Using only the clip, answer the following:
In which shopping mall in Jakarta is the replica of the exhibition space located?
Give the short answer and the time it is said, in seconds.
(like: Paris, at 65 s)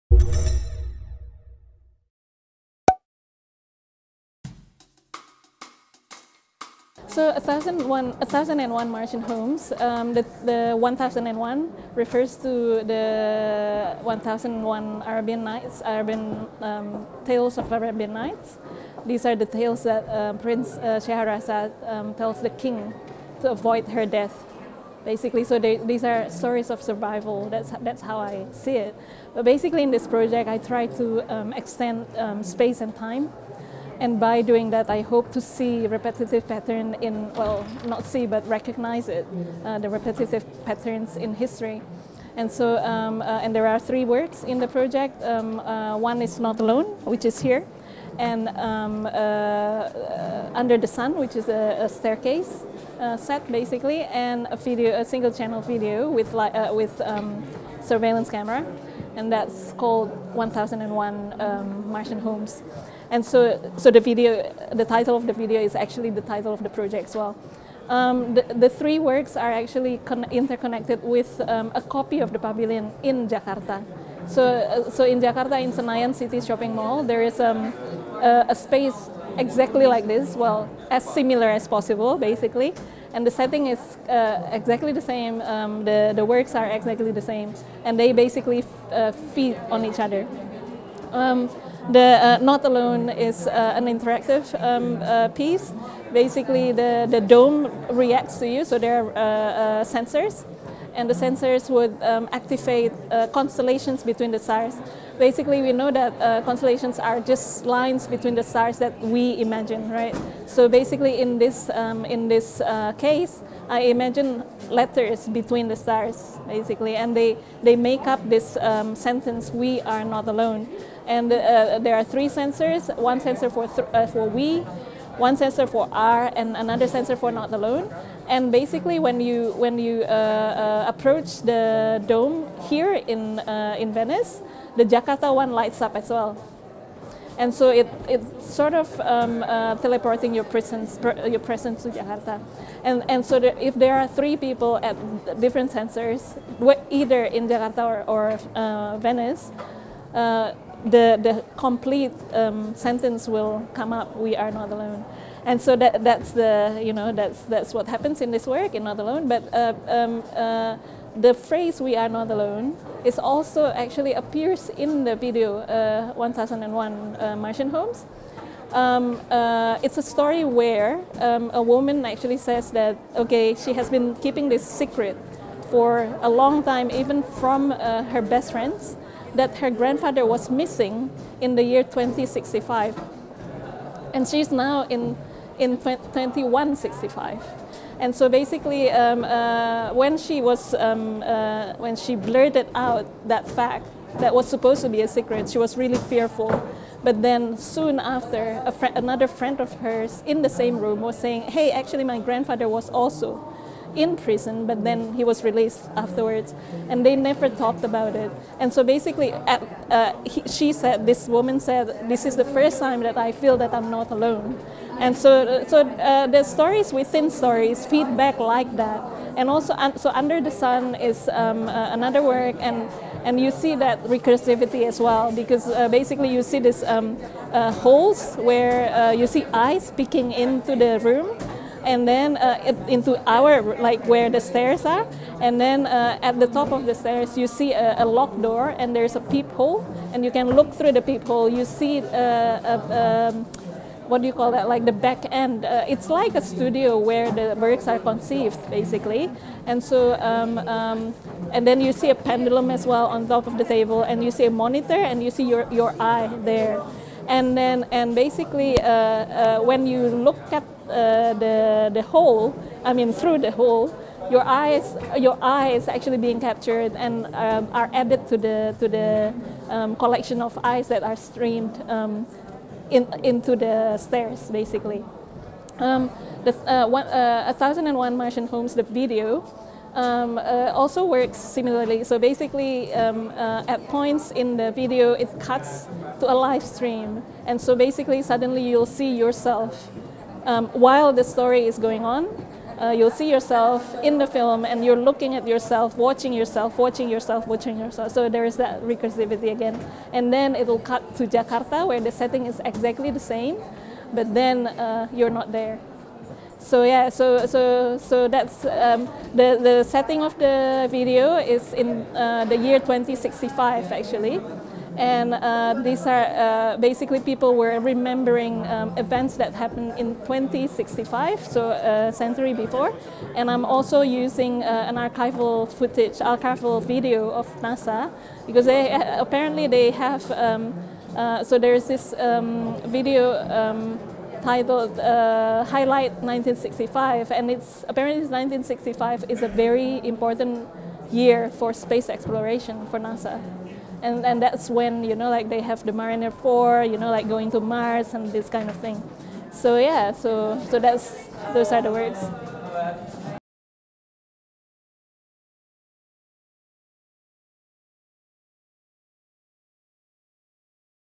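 Senayan City, at 75 s.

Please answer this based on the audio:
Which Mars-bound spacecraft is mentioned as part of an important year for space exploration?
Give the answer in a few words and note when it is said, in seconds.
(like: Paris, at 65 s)
Mariner 4, at 345 s.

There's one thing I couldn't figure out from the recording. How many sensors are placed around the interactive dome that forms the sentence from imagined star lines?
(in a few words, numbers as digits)
3.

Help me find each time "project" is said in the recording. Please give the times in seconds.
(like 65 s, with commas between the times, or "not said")
30 s, 44 s, 66 s.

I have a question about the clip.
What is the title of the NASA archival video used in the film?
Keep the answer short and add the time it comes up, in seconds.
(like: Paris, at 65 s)
Highlight 1965, at 335 s.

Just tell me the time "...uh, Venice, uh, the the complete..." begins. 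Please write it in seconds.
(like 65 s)
148 s.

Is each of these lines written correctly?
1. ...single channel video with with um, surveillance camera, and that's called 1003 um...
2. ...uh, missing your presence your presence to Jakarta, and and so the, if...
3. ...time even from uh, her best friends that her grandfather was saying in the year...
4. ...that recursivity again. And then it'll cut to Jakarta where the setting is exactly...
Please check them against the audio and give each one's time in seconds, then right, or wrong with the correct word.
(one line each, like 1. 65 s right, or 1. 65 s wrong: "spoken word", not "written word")
1. 55 s wrong: "1001", not "1003"
2. 139 s wrong: "teleporting", not "missing"
3. 176 s wrong: "missing", not "saying"
4. 298 s right.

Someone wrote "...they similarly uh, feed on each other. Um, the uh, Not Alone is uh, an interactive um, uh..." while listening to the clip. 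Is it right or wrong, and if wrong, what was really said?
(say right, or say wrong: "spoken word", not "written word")
wrong: "basically", not "similarly".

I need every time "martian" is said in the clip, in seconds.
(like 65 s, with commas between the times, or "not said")
8 s, 61 s, 167 s, 278 s.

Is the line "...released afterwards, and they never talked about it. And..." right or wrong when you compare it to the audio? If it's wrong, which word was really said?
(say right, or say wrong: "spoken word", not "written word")
right.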